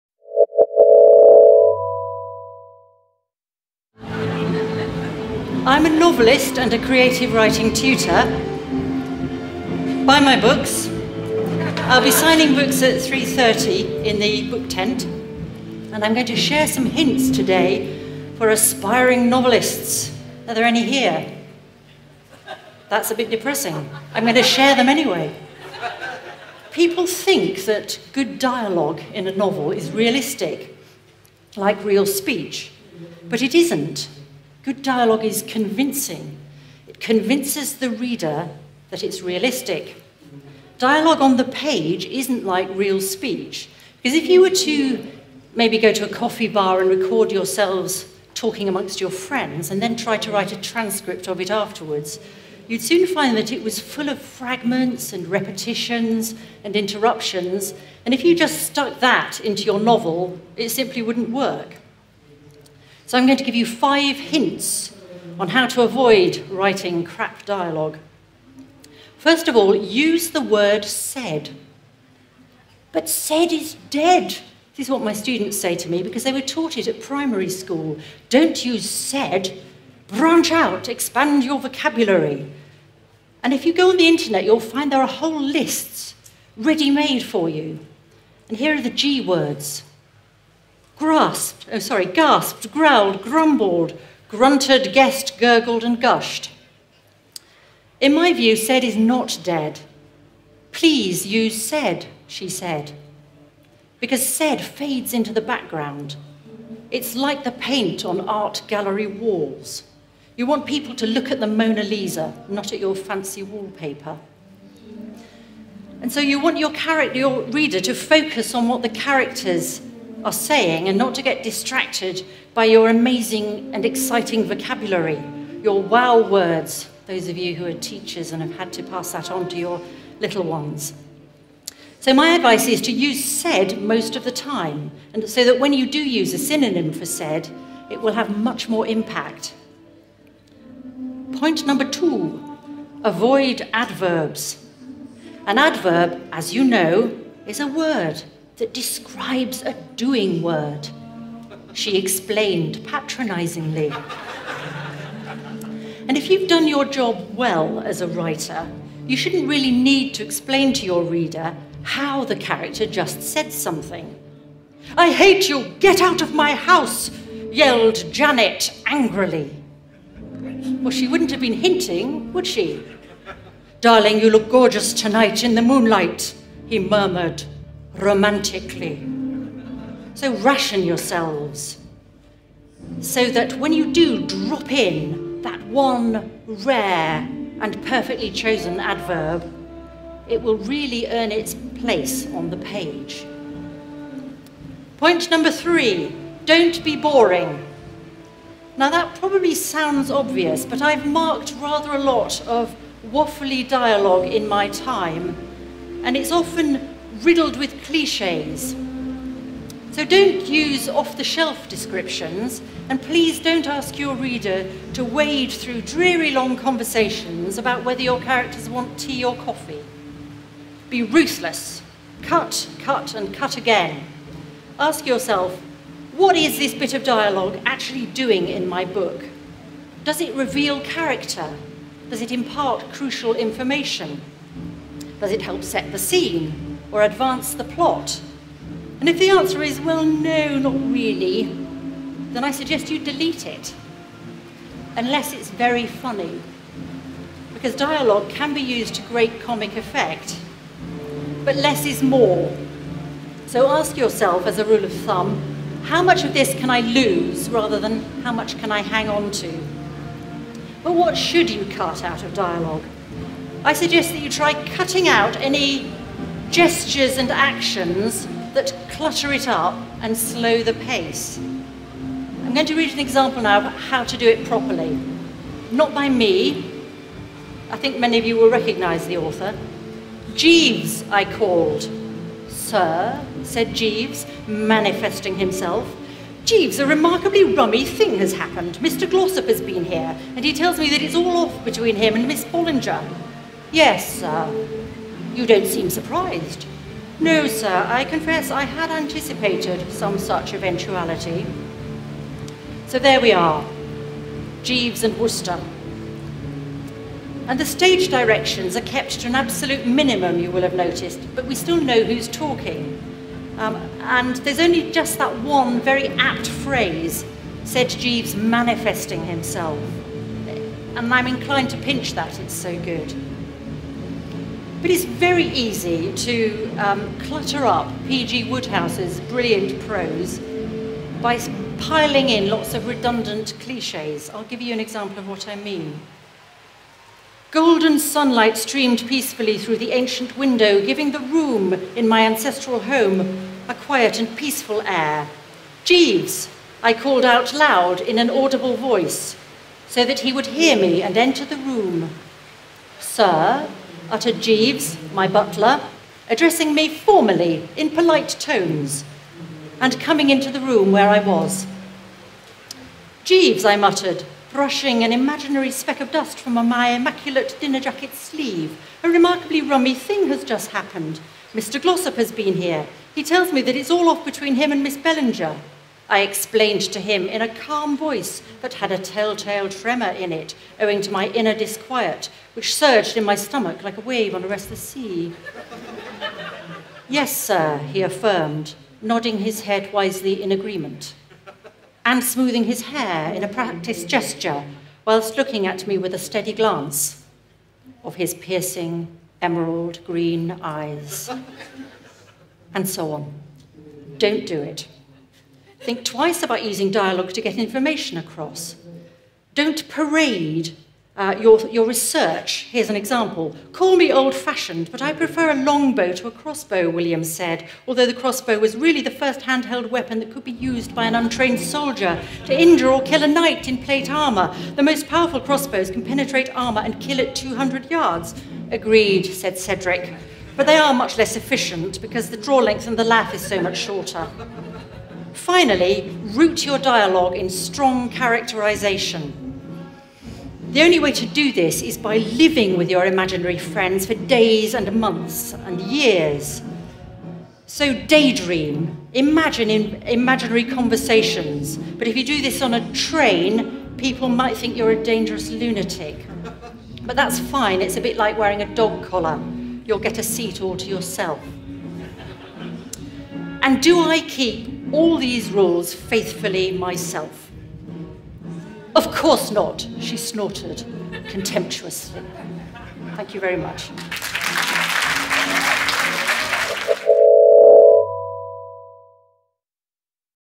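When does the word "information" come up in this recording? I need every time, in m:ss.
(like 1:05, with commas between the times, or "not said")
3:53, 6:47.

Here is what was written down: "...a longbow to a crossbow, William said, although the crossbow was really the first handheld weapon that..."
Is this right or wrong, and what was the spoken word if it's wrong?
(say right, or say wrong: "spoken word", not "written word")
right.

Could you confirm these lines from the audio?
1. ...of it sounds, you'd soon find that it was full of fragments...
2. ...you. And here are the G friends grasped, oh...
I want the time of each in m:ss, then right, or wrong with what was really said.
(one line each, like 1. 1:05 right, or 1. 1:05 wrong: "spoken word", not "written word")
1. 0:51 wrong: "afterwards", not "sounds"
2. 1:27 wrong: "words", not "friends".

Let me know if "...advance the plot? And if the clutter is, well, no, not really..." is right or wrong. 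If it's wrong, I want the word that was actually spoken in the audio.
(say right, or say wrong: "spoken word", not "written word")
wrong: "answer", not "clutter".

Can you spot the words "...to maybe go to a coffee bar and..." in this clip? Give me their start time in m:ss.
0:44.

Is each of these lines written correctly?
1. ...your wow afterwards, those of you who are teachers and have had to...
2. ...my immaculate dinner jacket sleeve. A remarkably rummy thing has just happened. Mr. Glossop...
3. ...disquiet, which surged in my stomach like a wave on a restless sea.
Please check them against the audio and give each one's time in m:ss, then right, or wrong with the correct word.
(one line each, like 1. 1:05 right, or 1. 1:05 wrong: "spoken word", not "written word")
1. 2:05 wrong: "words", not "afterwards"
2. 6:06 right
3. 6:21 right.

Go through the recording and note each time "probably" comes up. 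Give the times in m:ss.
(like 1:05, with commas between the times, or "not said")
3:19.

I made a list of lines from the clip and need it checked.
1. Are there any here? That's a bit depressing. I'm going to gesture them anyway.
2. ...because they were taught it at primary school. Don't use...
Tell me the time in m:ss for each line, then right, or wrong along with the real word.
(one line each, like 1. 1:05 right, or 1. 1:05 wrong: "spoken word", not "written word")
1. 0:20 wrong: "share", not "gesture"
2. 1:16 right.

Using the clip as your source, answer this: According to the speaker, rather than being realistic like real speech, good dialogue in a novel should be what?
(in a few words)
Convincing.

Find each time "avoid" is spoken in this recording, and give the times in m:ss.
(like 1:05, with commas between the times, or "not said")
1:05, 2:23.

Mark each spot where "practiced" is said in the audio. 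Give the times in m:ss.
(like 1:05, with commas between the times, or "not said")
6:33.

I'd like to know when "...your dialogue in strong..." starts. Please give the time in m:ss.
7:16.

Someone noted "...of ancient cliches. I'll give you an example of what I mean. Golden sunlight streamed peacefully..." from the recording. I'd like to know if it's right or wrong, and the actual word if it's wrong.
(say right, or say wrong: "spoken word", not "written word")
wrong: "redundant", not "ancient".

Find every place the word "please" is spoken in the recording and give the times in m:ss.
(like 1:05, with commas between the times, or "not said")
1:40, 3:33.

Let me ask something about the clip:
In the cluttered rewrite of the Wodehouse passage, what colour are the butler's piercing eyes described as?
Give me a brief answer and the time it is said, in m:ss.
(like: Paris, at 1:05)
Emerald green, at 6:39.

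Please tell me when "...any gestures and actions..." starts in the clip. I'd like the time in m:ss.
4:25.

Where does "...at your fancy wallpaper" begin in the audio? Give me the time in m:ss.
1:52.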